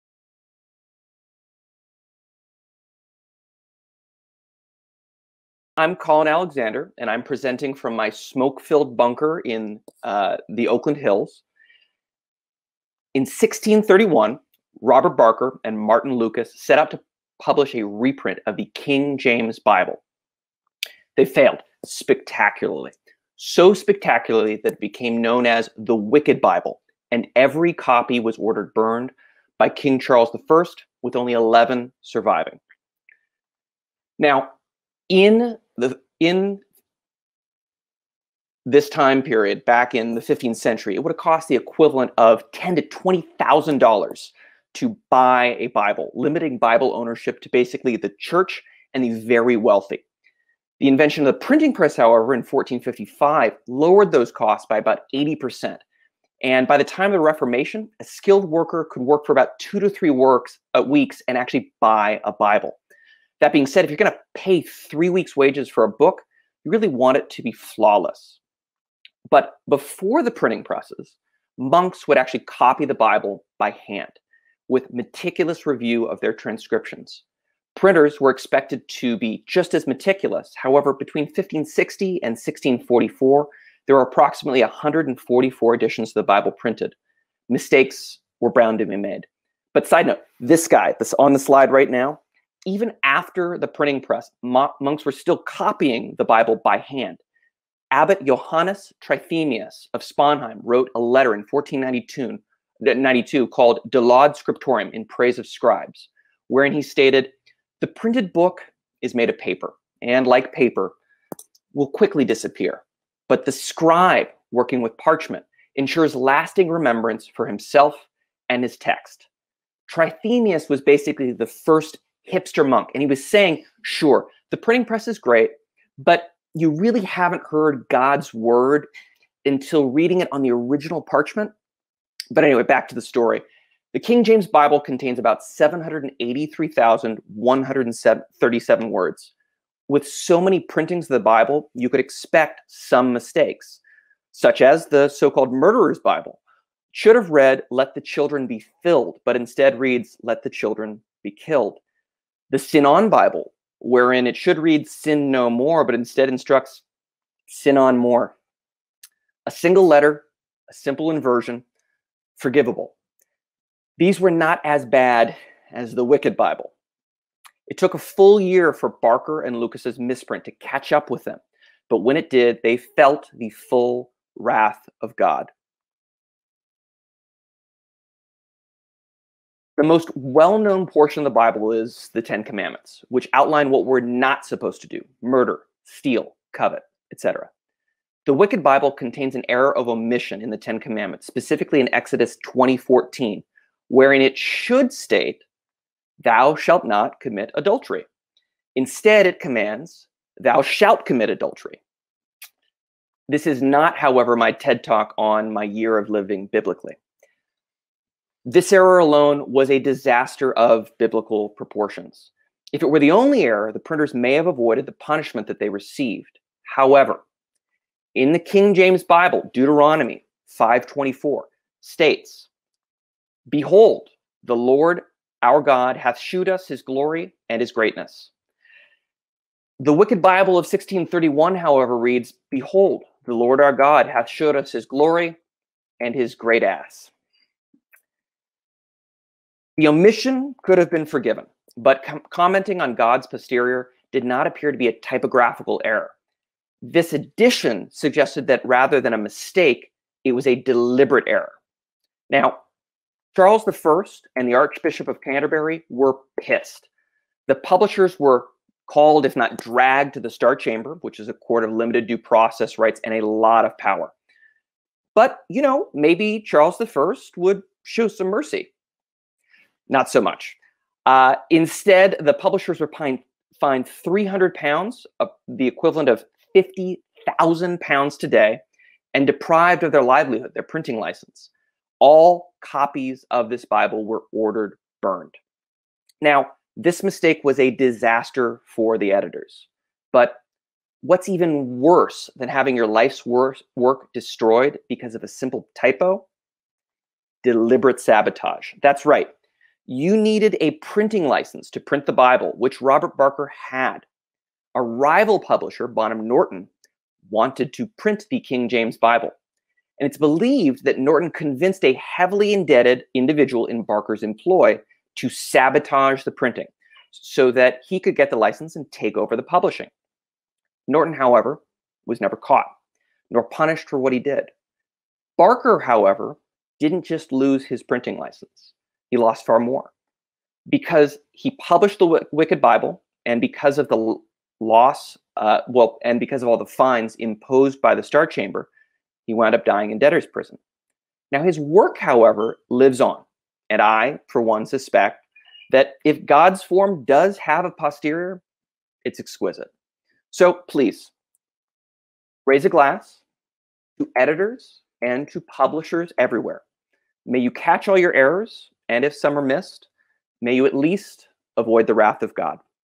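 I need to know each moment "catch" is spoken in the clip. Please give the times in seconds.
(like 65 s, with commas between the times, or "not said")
170 s, 357 s.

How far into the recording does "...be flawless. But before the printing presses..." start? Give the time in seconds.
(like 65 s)
67 s.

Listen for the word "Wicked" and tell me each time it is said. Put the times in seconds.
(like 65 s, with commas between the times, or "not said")
25 s, 166 s, 188 s, 229 s, 332 s.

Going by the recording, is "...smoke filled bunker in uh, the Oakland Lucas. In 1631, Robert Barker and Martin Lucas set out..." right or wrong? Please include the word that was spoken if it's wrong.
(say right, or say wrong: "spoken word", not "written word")
wrong: "Hills", not "Lucas".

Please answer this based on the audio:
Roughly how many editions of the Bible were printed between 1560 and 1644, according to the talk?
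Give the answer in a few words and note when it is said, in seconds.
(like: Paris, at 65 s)
144, at 84 s.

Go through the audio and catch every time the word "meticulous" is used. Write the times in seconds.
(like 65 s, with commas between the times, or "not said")
74 s, 79 s.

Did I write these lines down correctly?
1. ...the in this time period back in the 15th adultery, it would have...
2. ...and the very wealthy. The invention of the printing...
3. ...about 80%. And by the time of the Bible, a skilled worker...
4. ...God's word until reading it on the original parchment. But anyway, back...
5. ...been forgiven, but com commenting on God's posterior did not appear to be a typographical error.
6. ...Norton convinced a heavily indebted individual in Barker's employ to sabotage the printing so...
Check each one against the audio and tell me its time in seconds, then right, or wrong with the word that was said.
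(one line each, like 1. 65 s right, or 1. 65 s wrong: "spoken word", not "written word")
1. 35 s wrong: "century", not "adultery"
2. 48 s right
3. 54 s wrong: "Reformation", not "Bible"
4. 127 s right
5. 240 s right
6. 310 s right.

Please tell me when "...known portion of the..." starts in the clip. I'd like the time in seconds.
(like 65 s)
180 s.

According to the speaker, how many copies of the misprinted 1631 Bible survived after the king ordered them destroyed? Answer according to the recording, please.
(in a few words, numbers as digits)
11.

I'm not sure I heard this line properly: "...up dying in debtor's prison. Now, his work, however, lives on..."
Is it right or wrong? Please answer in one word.
right.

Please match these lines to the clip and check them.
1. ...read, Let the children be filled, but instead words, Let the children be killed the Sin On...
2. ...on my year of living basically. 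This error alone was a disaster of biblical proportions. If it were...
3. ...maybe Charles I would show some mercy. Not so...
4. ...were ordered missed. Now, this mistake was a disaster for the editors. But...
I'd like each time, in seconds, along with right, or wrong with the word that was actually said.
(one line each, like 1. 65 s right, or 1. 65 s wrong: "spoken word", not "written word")
1. 147 s wrong: "reads", not "words"
2. 205 s wrong: "biblically", not "basically"
3. 265 s right
4. 284 s wrong: "burned", not "missed".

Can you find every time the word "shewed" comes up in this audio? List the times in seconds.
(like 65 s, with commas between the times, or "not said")
226 s, 234 s.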